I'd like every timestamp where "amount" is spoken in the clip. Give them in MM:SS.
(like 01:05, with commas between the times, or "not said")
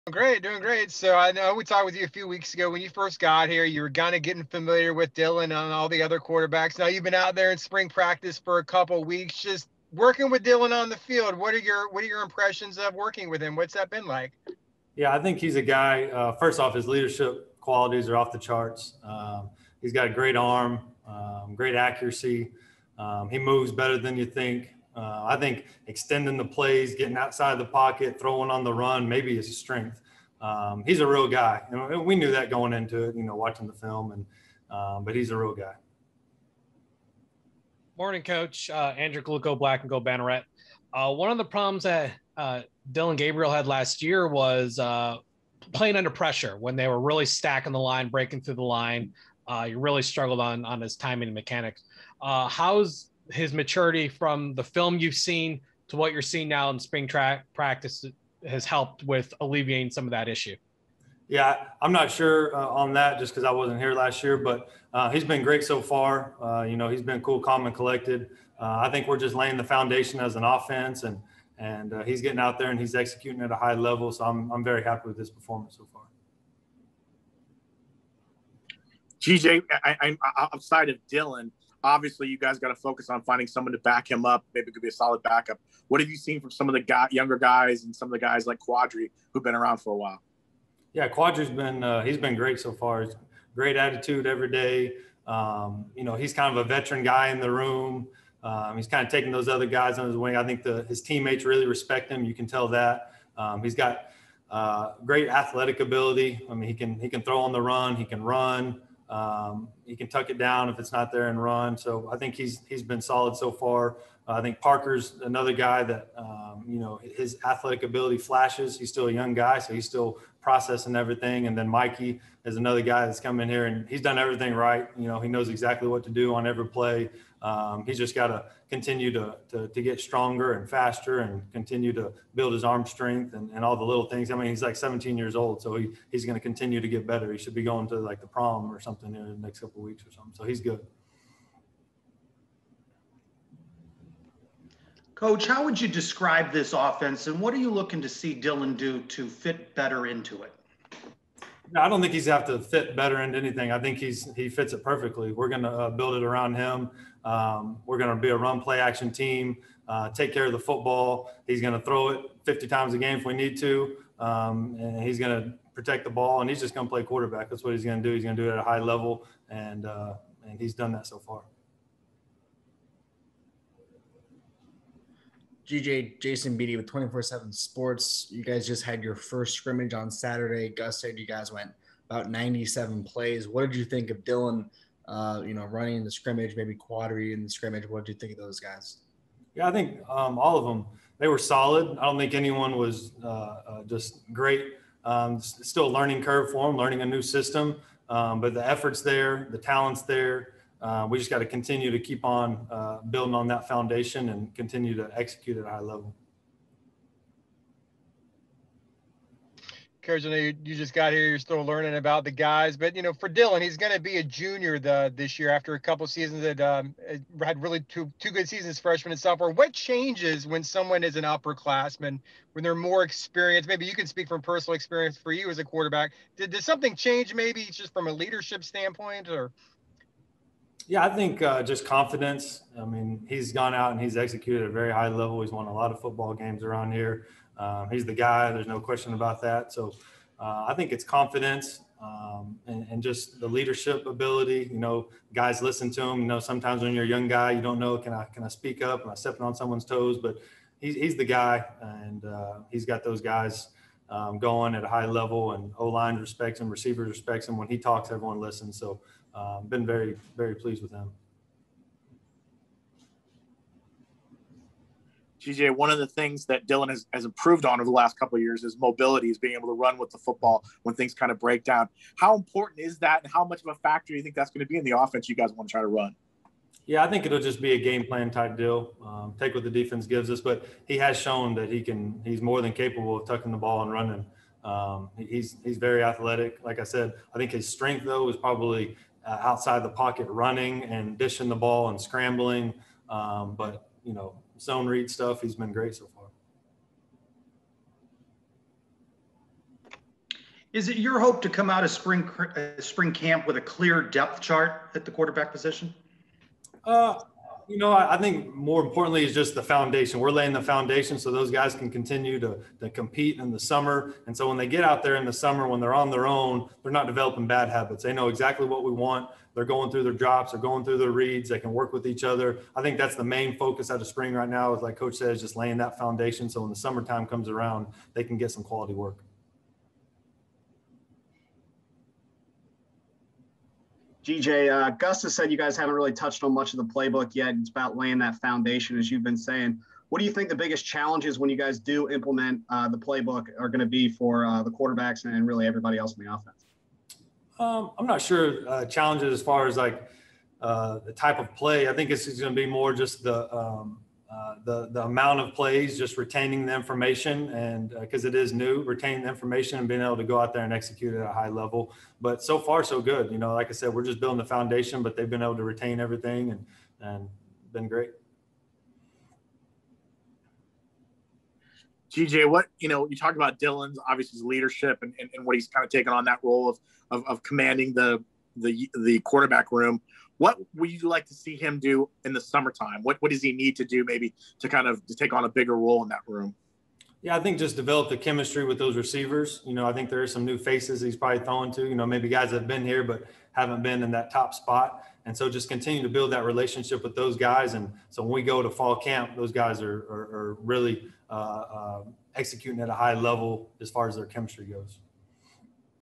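05:55.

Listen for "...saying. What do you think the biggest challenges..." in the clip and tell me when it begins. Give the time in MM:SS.
05:39.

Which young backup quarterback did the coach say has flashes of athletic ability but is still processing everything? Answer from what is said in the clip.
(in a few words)
Parker.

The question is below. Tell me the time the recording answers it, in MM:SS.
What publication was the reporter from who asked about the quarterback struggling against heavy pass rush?
00:39.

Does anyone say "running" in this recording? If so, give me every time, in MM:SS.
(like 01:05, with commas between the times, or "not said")
03:05, 04:43, 04:50.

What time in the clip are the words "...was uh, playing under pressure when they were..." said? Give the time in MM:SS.
00:44.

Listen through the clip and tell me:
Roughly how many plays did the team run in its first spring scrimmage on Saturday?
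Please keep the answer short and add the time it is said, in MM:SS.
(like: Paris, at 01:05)
97, at 03:02.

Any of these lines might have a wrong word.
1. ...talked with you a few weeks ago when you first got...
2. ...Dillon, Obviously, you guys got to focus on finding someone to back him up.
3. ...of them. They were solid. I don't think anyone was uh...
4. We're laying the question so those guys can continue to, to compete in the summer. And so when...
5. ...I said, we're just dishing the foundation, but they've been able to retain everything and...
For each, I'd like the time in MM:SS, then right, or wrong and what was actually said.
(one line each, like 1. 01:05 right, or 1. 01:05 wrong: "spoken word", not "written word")
1. 00:01 right
2. 01:21 right
3. 03:10 right
4. 05:10 wrong: "foundation", not "question"
5. 06:03 wrong: "building", not "dishing".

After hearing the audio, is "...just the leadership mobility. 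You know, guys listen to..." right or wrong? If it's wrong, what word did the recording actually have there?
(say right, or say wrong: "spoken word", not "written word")
wrong: "ability", not "mobility".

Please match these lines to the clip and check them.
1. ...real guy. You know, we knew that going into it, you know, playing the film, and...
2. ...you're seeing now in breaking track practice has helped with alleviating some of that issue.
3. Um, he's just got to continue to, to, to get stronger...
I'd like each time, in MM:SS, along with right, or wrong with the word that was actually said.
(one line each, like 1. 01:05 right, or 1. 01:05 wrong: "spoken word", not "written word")
1. 00:31 wrong: "watching", not "playing"
2. 00:56 wrong: "spring", not "breaking"
3. 02:07 right.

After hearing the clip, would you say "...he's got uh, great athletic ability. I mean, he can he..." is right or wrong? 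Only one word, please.
right.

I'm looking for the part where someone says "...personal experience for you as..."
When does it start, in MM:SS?
03:44.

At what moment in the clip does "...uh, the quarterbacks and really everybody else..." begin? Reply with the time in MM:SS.
05:44.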